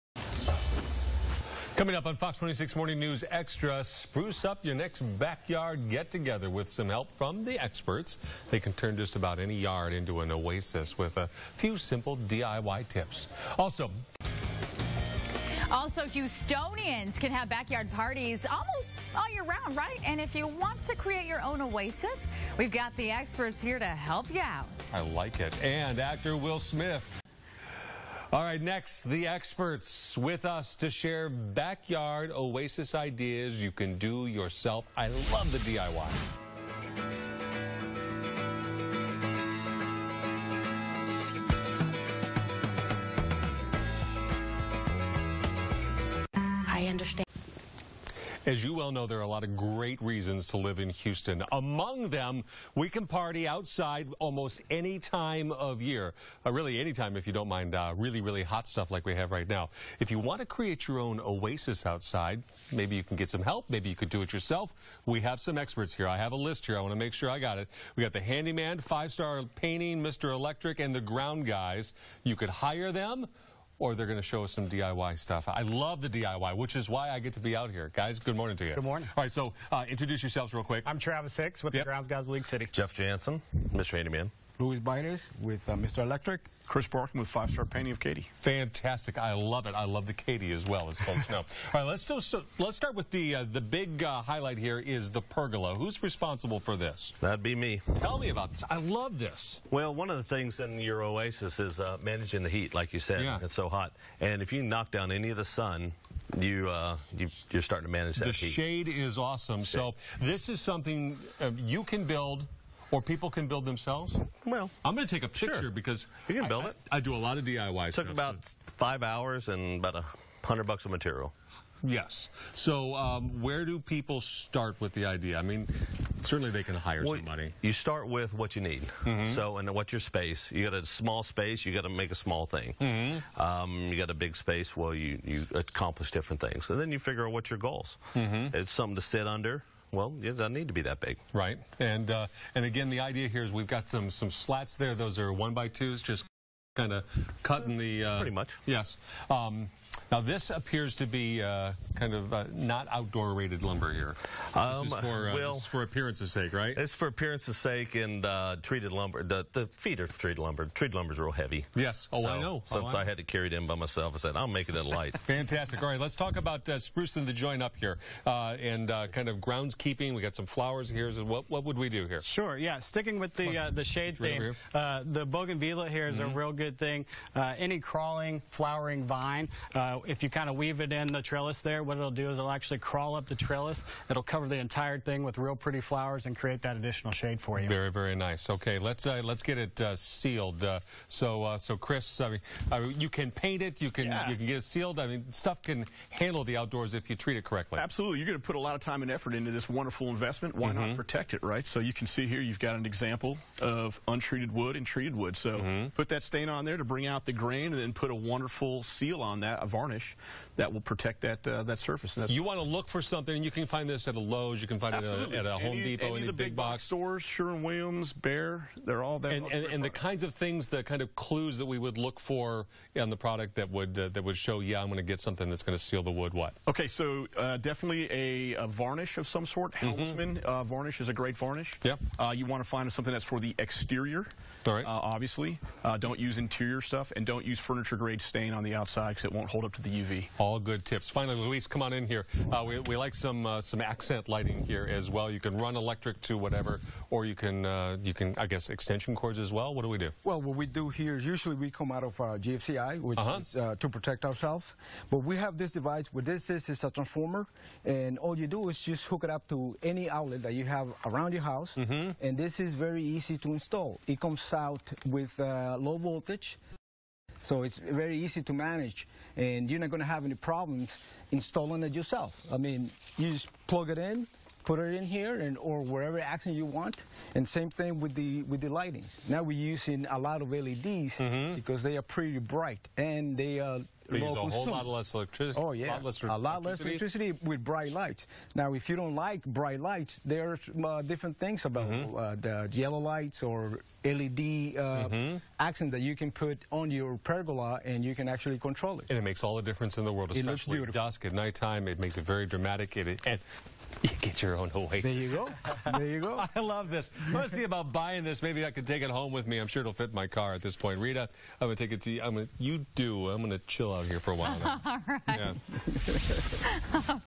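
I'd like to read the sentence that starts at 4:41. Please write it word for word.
because they are pretty bright and they are we a whole lot less electricity.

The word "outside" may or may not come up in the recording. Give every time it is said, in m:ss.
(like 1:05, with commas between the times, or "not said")
0:53, 1:01, 3:58.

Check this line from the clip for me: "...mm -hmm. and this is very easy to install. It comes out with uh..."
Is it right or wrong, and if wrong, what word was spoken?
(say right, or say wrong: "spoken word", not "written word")
right.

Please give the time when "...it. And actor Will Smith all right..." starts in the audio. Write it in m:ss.
0:25.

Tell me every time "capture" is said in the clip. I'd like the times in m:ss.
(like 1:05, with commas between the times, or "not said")
not said.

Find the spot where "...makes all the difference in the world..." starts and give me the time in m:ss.
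4:59.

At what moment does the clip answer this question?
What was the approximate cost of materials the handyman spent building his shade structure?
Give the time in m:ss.
1:59.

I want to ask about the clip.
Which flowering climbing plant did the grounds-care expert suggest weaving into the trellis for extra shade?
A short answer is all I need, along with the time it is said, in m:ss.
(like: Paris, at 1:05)
bougainvillea, at 2:55.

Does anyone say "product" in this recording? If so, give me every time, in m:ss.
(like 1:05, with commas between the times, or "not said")
3:43.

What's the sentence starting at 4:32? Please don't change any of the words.
I mean, you just plug it in, put it in here, and or wherever accent you want.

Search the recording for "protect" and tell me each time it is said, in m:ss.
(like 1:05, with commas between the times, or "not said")
3:21, 3:30, 4:13.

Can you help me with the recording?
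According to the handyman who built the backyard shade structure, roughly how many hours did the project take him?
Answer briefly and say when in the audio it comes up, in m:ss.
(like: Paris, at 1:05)
5, at 1:58.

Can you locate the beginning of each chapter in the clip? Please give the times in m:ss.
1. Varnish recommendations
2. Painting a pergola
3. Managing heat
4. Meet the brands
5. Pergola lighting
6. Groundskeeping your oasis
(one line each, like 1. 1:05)
1. 3:28
2. 3:06
3. 1:35
4. 1:20
5. 3:56
6. 2:42.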